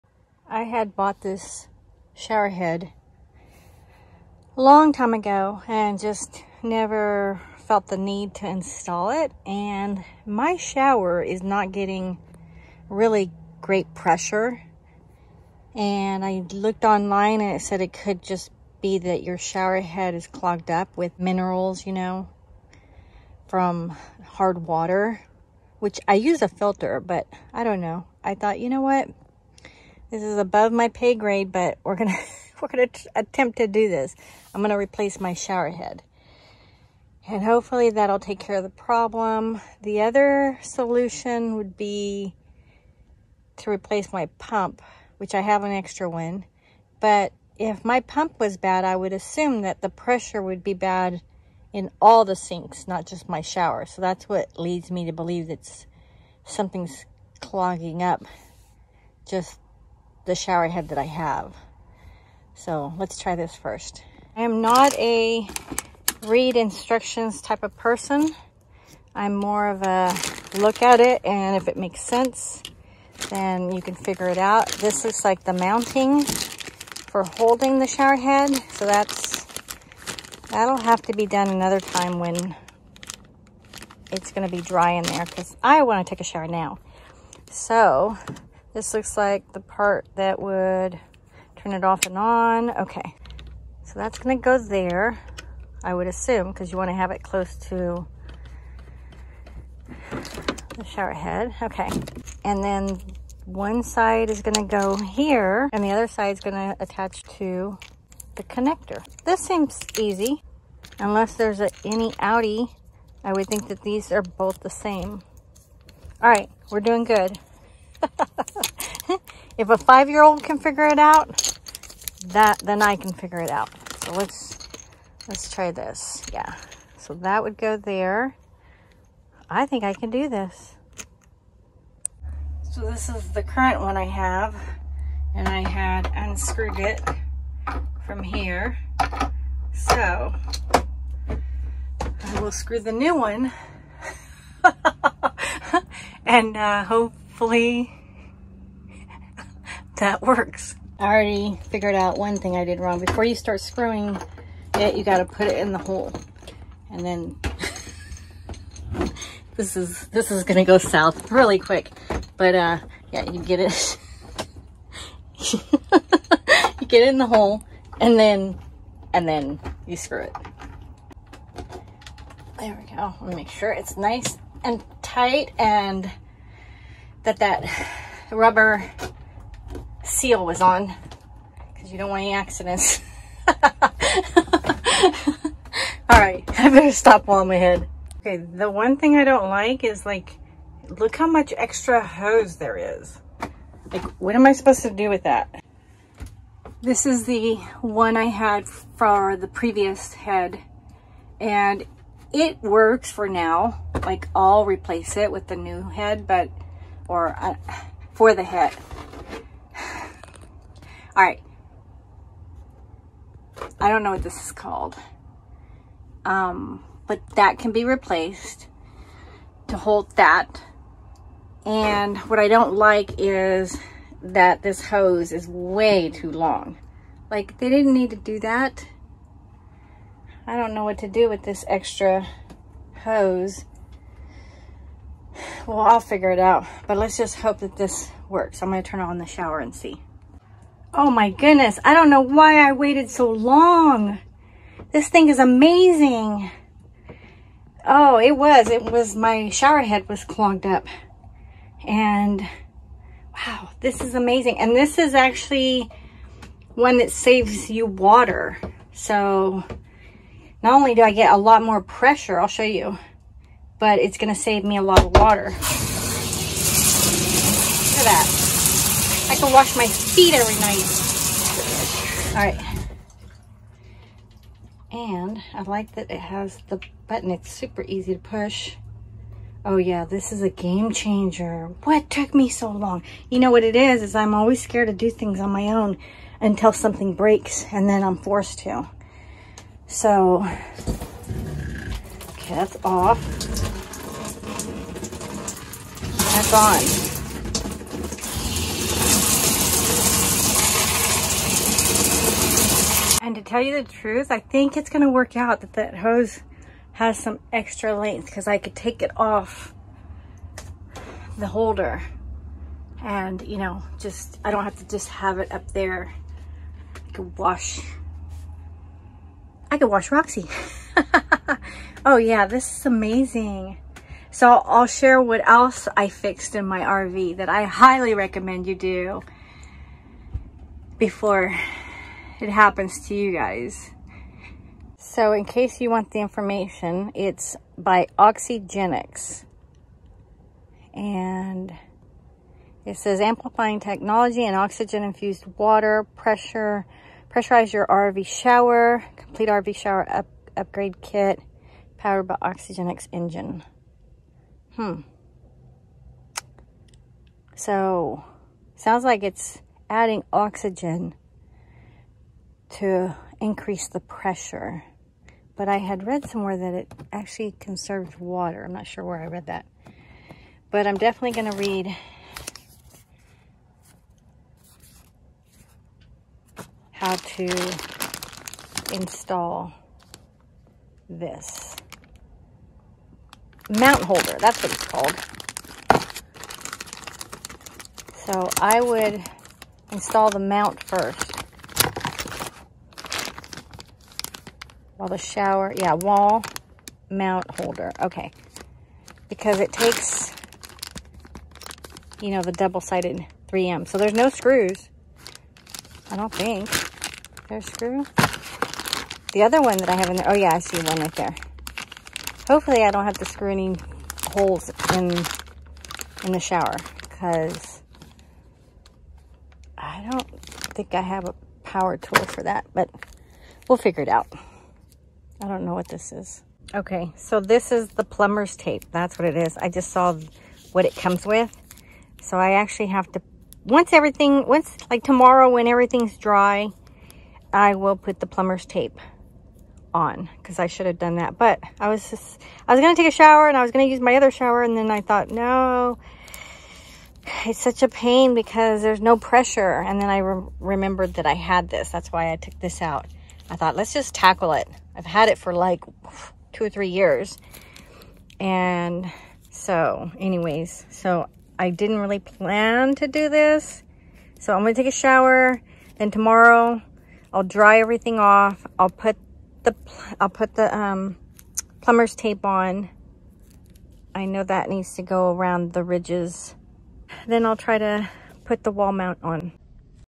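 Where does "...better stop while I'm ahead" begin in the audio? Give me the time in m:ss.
3:06.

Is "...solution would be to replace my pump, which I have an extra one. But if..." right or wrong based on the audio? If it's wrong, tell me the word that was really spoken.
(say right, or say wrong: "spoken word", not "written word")
right.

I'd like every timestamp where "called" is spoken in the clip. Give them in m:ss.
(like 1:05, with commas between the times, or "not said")
3:34, 6:24.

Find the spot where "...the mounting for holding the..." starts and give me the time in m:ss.
1:15.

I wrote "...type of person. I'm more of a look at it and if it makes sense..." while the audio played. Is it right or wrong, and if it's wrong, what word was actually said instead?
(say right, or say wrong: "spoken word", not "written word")
right.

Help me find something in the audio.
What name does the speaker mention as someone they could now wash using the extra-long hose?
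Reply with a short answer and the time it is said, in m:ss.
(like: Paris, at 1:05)
Roxy, at 5:20.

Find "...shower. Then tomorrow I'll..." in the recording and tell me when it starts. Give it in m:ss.
7:44.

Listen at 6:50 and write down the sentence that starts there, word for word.
Oh, yeah, I see one right there.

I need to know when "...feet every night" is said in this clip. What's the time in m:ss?
4:29.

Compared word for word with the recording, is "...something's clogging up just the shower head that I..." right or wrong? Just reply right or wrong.
right.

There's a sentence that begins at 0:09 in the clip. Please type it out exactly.
And my shower is not getting really great pressure.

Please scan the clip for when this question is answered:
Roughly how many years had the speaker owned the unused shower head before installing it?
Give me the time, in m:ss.
7:36.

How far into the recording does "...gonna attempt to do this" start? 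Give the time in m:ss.
0:32.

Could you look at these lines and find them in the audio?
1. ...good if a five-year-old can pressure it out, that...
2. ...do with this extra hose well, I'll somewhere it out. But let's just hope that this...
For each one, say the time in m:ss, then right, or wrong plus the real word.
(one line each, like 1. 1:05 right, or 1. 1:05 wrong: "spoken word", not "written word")
1. 1:57 wrong: "figure", not "pressure"
2. 3:51 wrong: "figure", not "somewhere".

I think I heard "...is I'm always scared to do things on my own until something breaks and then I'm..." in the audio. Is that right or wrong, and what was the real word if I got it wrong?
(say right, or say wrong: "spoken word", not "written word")
right.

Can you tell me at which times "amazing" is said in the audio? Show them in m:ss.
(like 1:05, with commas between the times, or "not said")
4:05, 4:14, 5:22.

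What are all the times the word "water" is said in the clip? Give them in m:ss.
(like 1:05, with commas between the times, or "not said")
0:24, 4:17, 4:25, 5:45, 6:08.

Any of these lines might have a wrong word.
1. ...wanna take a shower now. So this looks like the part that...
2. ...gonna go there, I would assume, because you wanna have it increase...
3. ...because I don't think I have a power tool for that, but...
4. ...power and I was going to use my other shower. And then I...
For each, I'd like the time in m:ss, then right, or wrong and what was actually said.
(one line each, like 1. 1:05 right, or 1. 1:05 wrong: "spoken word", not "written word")
1. 1:25 right
2. 1:34 wrong: "close", not "increase"
3. 6:57 right
4. 7:23 wrong: "shower", not "power".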